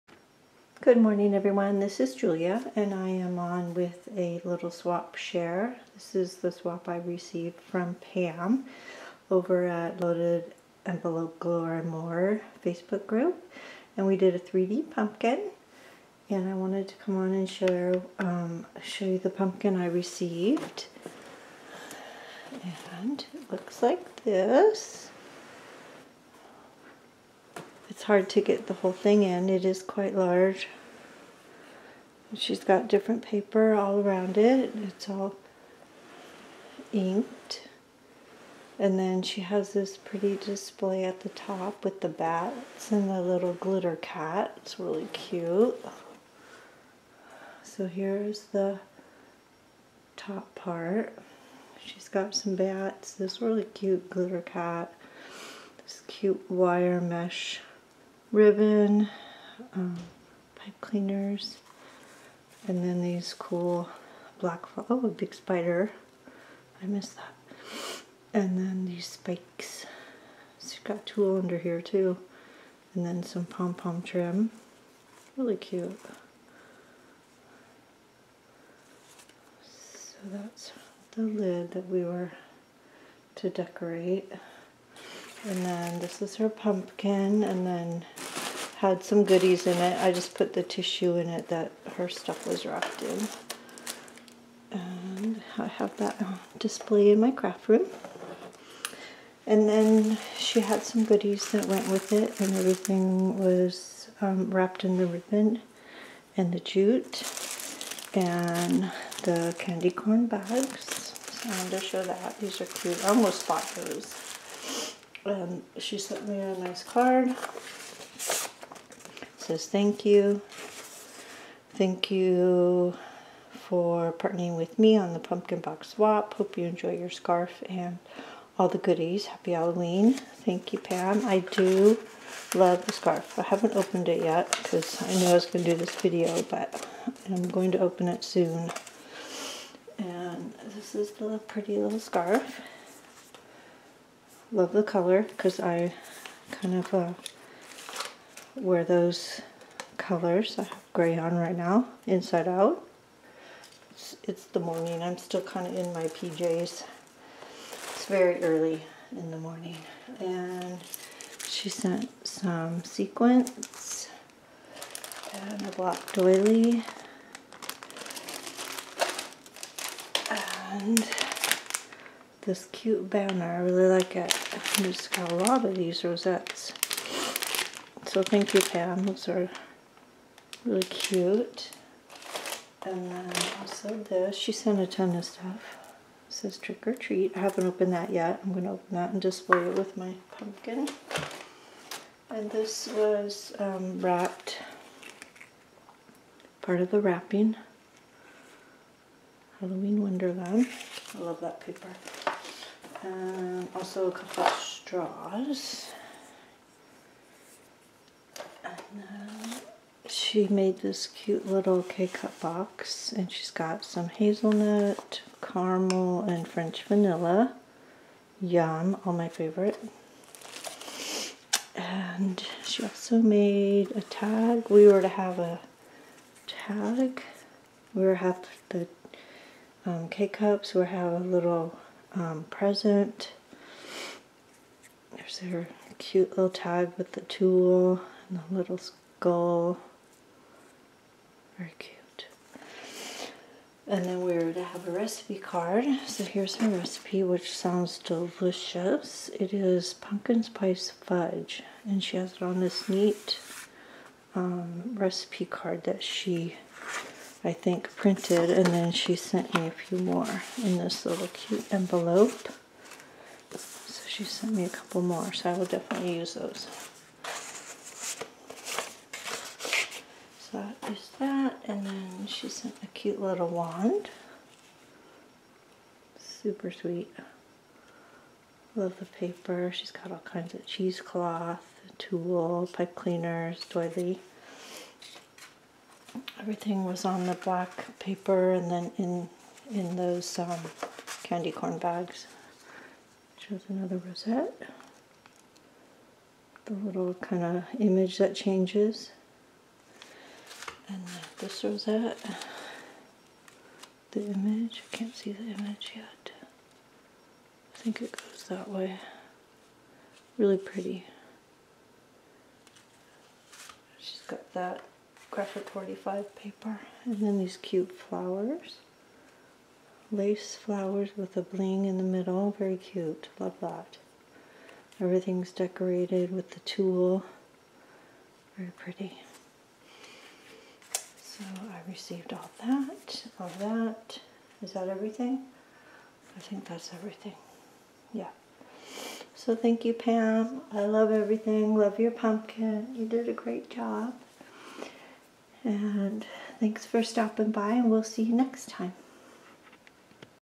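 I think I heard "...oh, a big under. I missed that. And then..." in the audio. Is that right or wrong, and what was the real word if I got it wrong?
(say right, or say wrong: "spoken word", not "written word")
wrong: "spider", not "under".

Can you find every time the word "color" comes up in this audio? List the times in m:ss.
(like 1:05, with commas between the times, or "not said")
2:24, 2:29.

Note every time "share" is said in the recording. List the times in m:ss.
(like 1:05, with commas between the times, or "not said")
0:05, 0:17.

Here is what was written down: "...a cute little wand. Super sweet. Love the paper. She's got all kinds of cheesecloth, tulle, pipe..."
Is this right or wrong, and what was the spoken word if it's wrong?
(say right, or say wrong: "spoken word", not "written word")
right.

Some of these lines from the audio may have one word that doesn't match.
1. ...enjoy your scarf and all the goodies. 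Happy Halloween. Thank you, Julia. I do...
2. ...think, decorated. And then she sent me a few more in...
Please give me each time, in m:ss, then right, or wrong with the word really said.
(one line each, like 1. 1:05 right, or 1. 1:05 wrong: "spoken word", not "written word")
1. 2:06 wrong: "Pam", not "Julia"
2. 4:17 wrong: "printed", not "decorated".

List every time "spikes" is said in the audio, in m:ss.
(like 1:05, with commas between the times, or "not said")
1:09.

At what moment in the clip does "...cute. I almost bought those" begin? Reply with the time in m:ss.
1:52.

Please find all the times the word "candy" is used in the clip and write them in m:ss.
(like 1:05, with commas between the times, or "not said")
1:49, 4:51.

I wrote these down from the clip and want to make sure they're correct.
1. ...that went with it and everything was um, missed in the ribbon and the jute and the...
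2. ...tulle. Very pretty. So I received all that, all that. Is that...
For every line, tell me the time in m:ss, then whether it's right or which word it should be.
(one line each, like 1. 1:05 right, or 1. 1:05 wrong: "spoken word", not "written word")
1. 1:41 wrong: "wrapped", not "missed"
2. 5:26 right.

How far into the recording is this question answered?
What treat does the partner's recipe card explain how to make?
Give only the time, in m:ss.
4:09.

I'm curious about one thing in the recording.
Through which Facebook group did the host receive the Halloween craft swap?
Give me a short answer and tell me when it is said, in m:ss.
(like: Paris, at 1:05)
Loaded Envelope Galore More, at 0:10.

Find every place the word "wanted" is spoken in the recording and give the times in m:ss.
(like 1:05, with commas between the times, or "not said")
0:16, 1:51.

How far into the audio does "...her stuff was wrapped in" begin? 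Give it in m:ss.
1:31.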